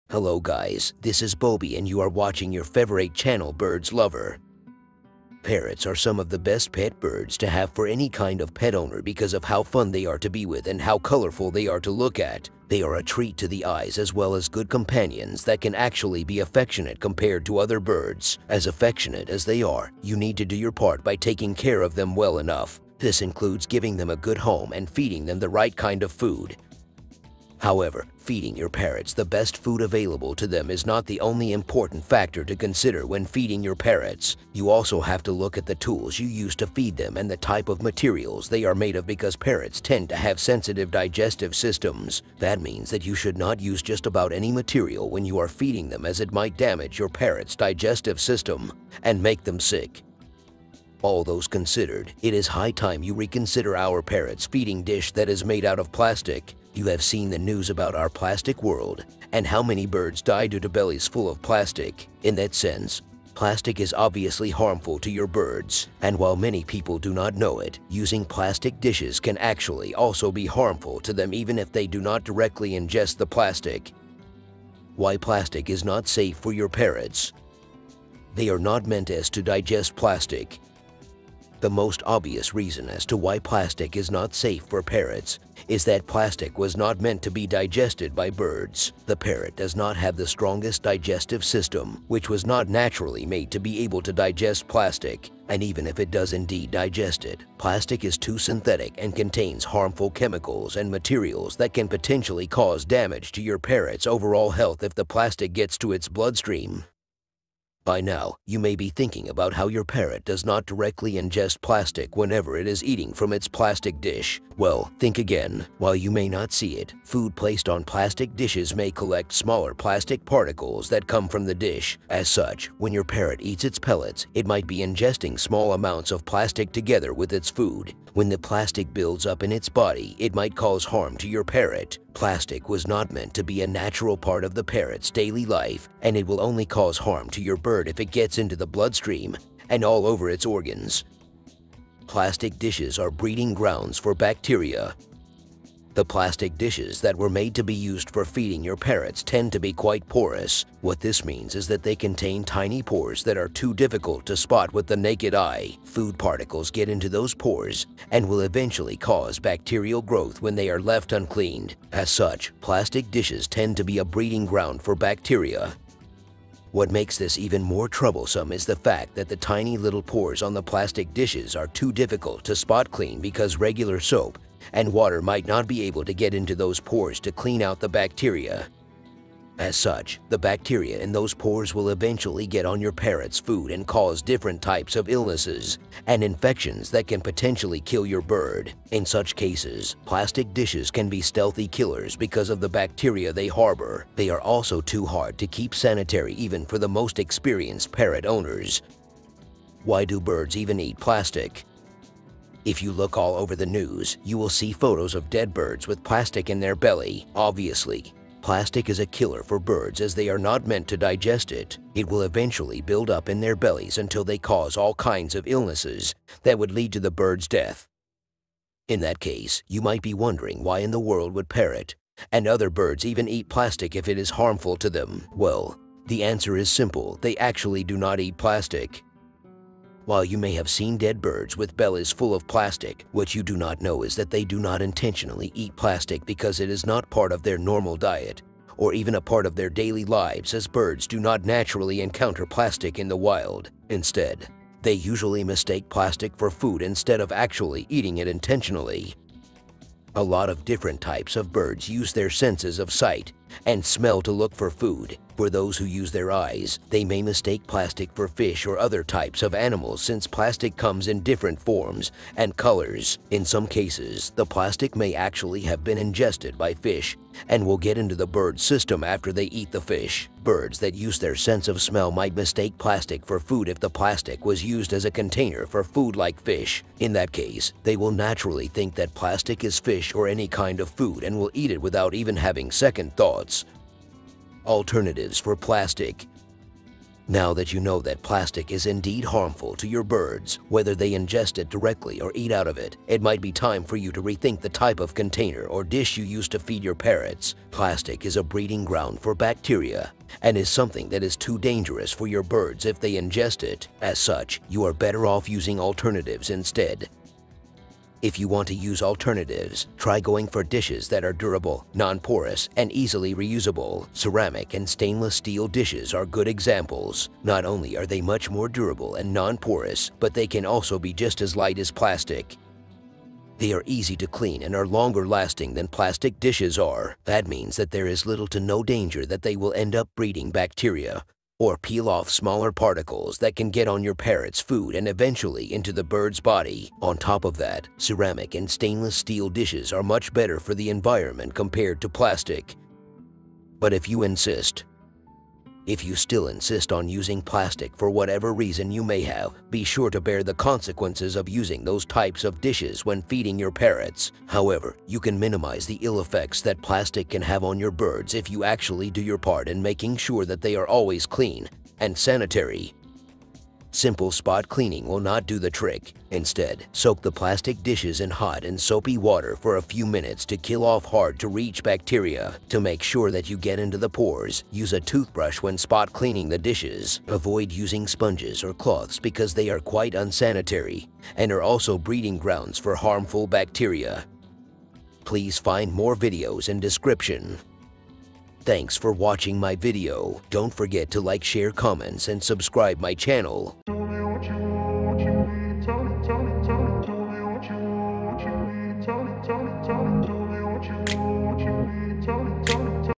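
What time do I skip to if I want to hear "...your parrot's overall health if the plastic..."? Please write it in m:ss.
1:43.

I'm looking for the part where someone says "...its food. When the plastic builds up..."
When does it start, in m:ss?
2:07.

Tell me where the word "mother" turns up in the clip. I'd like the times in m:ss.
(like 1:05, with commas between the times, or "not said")
not said.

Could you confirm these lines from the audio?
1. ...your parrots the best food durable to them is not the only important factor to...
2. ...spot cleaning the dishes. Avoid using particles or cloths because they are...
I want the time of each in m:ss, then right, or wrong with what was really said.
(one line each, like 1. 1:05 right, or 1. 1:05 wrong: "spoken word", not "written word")
1. 0:28 wrong: "available", not "durable"
2. 6:15 wrong: "sponges", not "particles".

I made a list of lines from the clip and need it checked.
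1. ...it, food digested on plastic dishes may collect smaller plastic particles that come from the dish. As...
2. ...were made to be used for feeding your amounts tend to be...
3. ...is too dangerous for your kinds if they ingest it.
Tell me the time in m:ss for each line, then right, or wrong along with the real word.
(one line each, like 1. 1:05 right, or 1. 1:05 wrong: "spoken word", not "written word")
1. 1:56 wrong: "placed", not "digested"
2. 2:27 wrong: "parrots", not "amounts"
3. 5:01 wrong: "birds", not "kinds".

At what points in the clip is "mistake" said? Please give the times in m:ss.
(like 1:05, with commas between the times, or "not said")
4:05, 4:17, 4:32.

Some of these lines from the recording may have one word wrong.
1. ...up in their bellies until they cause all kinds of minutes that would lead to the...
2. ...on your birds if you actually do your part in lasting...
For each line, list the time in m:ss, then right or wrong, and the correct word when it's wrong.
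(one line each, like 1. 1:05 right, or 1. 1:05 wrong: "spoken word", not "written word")
1. 3:33 wrong: "illnesses", not "minutes"
2. 5:57 wrong: "making", not "lasting".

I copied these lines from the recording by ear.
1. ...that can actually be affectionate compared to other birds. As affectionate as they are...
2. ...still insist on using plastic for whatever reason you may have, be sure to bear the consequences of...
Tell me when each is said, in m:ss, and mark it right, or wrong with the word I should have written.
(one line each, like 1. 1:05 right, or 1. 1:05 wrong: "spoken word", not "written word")
1. 0:15 right
2. 5:46 right.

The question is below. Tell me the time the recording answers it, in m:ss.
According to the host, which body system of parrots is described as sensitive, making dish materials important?
0:40.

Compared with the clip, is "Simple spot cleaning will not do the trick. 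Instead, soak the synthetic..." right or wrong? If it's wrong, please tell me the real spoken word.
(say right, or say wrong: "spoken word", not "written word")
wrong: "plastic", not "synthetic".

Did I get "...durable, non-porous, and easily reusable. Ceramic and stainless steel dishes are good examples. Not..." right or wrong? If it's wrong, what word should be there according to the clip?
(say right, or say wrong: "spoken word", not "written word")
right.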